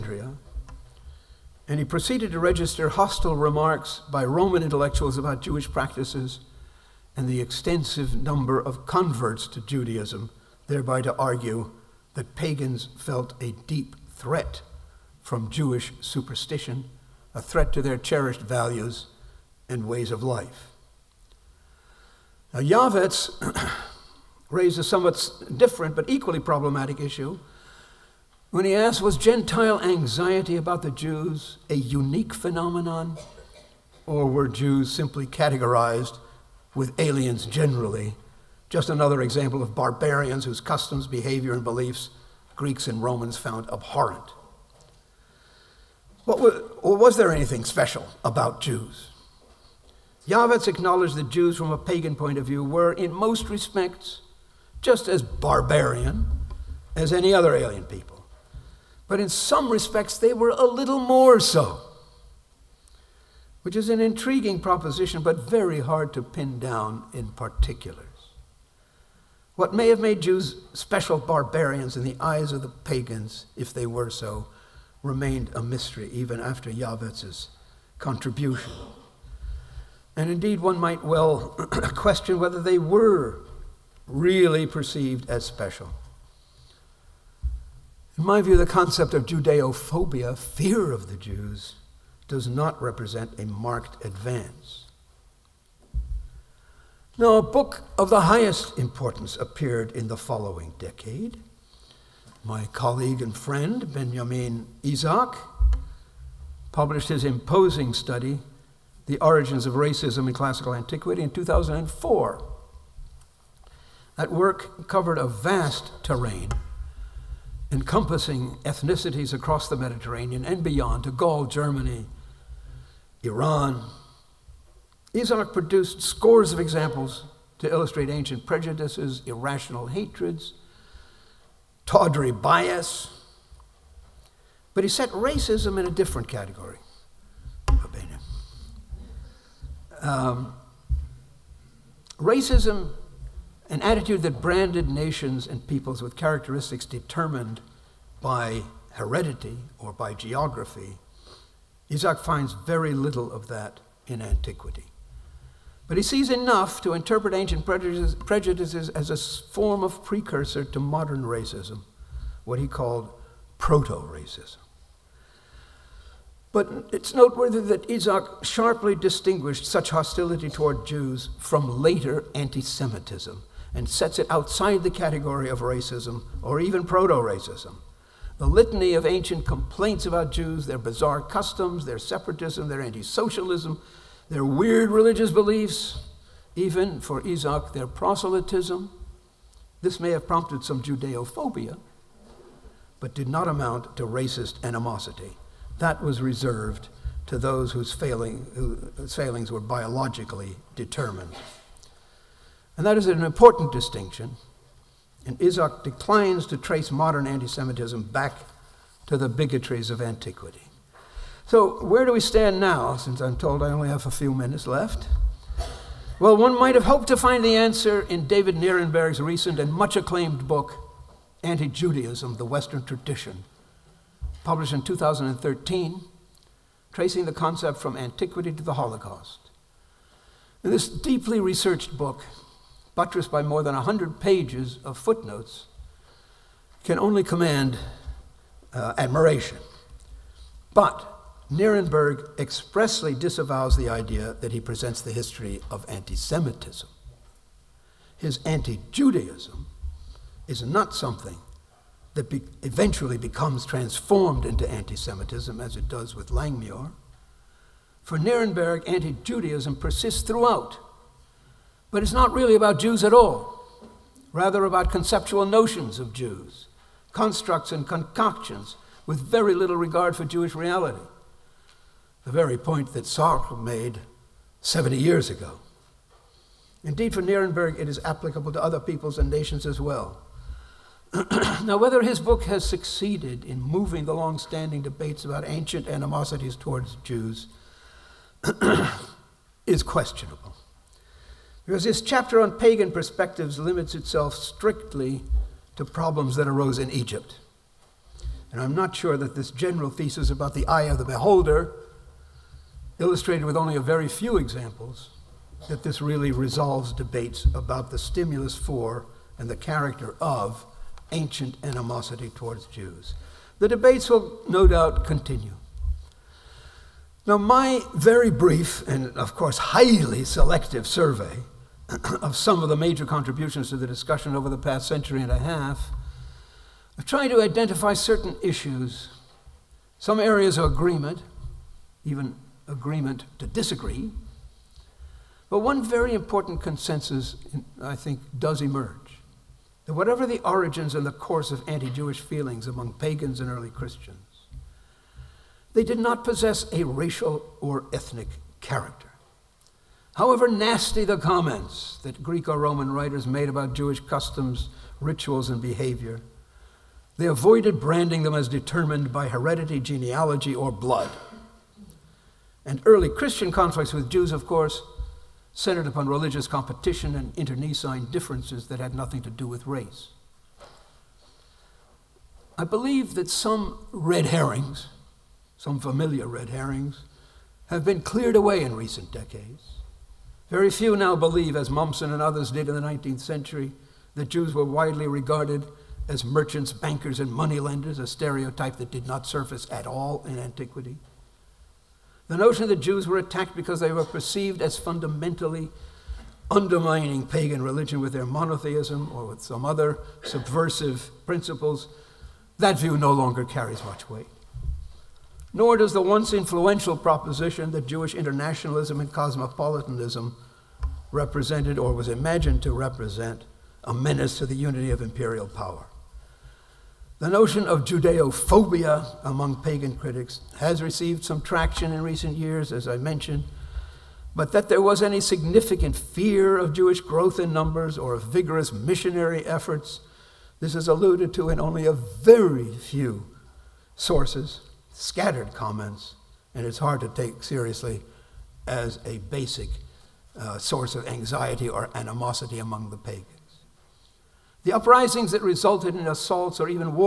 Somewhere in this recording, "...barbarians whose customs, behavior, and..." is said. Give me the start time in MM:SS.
00:39.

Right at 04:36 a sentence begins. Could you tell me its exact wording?
Indeed, for Nirenberg, it is applicable to other peoples and nations as well.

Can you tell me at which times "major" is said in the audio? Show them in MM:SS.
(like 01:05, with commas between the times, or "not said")
05:22.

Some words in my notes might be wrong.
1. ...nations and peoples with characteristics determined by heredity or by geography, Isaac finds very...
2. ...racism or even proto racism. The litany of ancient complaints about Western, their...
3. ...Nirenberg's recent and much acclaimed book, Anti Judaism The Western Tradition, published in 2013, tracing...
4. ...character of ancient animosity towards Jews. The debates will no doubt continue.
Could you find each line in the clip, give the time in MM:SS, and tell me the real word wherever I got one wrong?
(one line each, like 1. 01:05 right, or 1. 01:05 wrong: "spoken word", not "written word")
1. 02:24 right
2. 02:55 wrong: "Jews", not "Western"
3. 03:38 right
4. 05:09 right.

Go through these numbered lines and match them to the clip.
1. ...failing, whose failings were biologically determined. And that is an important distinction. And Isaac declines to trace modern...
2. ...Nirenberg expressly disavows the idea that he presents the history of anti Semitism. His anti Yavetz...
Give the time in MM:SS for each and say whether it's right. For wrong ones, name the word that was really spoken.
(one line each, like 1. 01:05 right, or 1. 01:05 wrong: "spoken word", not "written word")
1. 03:17 right
2. 04:01 wrong: "Judaism", not "Yavetz".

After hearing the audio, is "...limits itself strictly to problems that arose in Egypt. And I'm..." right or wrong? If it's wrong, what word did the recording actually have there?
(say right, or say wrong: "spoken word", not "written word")
right.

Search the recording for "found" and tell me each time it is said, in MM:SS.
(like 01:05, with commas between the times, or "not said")
00:43.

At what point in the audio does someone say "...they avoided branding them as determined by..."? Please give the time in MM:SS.
05:57.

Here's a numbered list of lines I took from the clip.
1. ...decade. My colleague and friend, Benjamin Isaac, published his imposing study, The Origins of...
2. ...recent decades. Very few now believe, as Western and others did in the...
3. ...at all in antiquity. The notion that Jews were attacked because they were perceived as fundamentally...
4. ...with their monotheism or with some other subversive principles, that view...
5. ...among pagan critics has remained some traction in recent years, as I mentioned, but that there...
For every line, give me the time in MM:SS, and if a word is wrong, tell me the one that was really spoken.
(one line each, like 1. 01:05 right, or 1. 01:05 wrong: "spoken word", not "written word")
1. 01:40 right
2. 06:18 wrong: "Mommsen", not "Western"
3. 06:29 right
4. 06:38 right
5. 06:59 wrong: "received", not "remained".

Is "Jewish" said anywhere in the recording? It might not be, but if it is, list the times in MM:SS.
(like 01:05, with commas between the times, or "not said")
00:05, 00:15, 04:30, 05:41, 05:53, 06:47, 07:06.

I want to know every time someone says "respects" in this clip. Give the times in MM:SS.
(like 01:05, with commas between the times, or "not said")
00:53, 00:59.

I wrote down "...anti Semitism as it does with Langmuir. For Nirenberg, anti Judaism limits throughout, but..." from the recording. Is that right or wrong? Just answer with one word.
wrong.